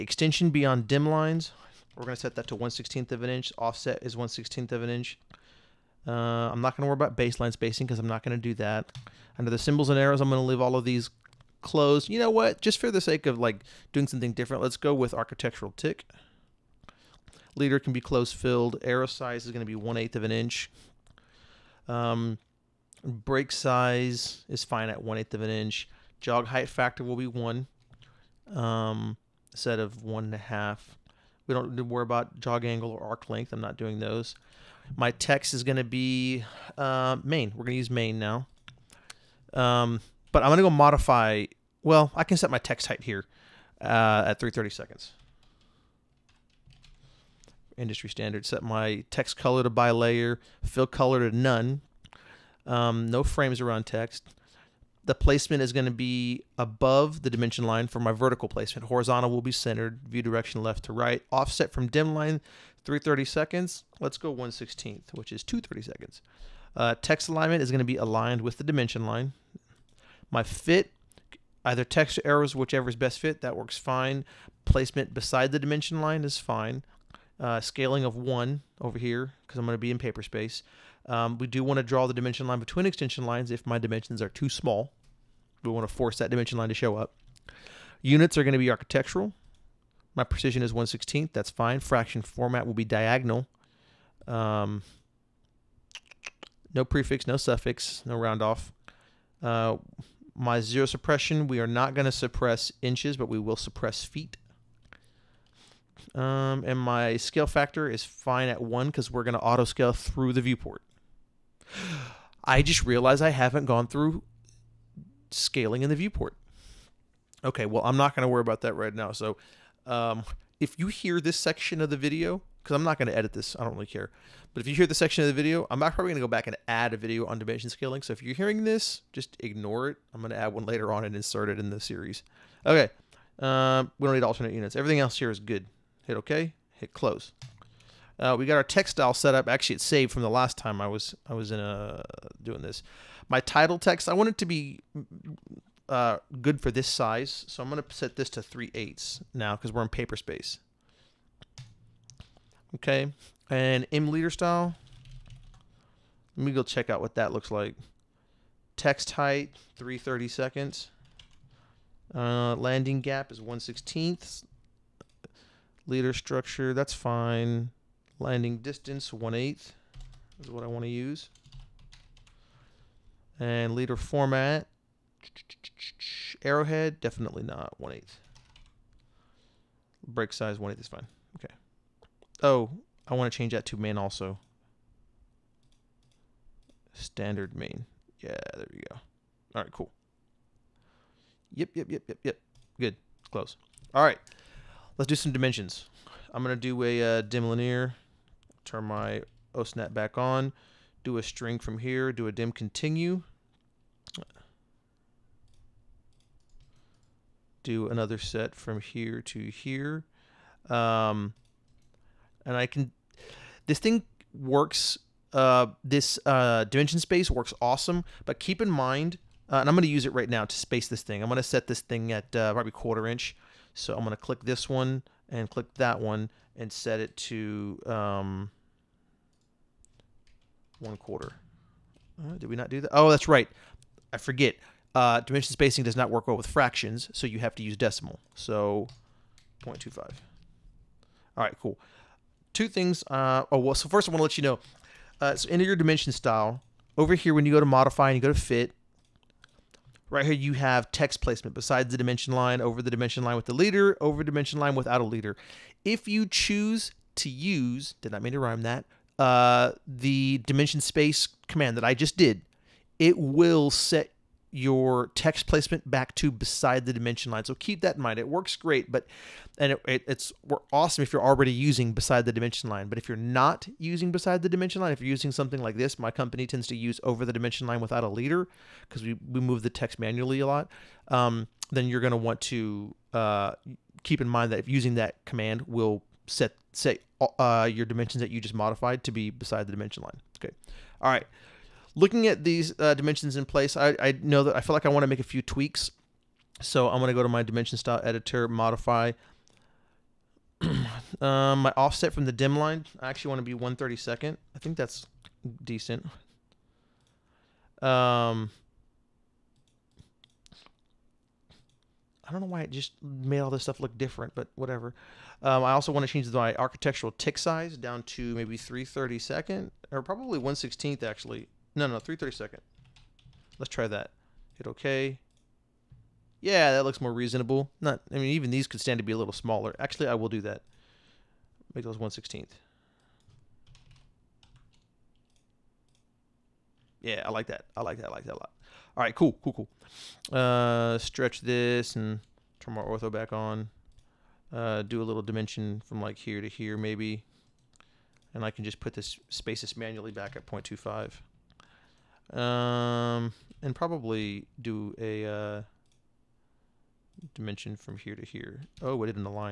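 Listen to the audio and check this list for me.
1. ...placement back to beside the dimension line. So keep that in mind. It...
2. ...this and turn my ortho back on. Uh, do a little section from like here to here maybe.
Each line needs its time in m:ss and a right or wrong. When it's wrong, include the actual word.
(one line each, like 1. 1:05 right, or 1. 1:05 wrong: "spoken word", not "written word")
1. 4:25 right
2. 5:41 wrong: "dimension", not "section".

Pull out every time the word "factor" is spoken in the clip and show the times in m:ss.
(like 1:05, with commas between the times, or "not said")
0:26, 1:47.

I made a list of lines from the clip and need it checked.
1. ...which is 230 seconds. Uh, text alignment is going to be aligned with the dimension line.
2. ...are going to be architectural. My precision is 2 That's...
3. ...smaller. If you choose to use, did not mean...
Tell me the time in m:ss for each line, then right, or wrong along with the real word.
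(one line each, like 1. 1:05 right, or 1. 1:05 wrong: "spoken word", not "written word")
1. 1:05 right
2. 1:28 wrong: "1", not "2"
3. 4:15 wrong: "leader", not "smaller".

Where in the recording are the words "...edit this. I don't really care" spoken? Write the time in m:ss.
2:03.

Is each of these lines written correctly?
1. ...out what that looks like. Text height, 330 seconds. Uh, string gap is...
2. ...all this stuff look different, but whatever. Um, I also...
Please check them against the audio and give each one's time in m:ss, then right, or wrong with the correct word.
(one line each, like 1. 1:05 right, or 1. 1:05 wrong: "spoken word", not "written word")
1. 2:36 wrong: "landing", not "string"
2. 5:13 right.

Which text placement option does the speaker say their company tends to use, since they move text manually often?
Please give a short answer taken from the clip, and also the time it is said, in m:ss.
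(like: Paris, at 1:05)
Over the dimension line without a leader, at 4:37.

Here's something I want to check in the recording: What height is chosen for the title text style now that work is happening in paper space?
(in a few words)
3/8 inch.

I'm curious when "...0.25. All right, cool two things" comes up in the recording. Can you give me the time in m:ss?
3:59.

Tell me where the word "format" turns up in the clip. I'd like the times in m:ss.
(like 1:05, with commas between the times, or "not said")
1:32, 2:53.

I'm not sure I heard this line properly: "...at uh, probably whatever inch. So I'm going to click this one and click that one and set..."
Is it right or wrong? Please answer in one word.
wrong.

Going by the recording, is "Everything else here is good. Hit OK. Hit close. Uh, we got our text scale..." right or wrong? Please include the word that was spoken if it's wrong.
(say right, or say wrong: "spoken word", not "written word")
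wrong: "style", not "scale".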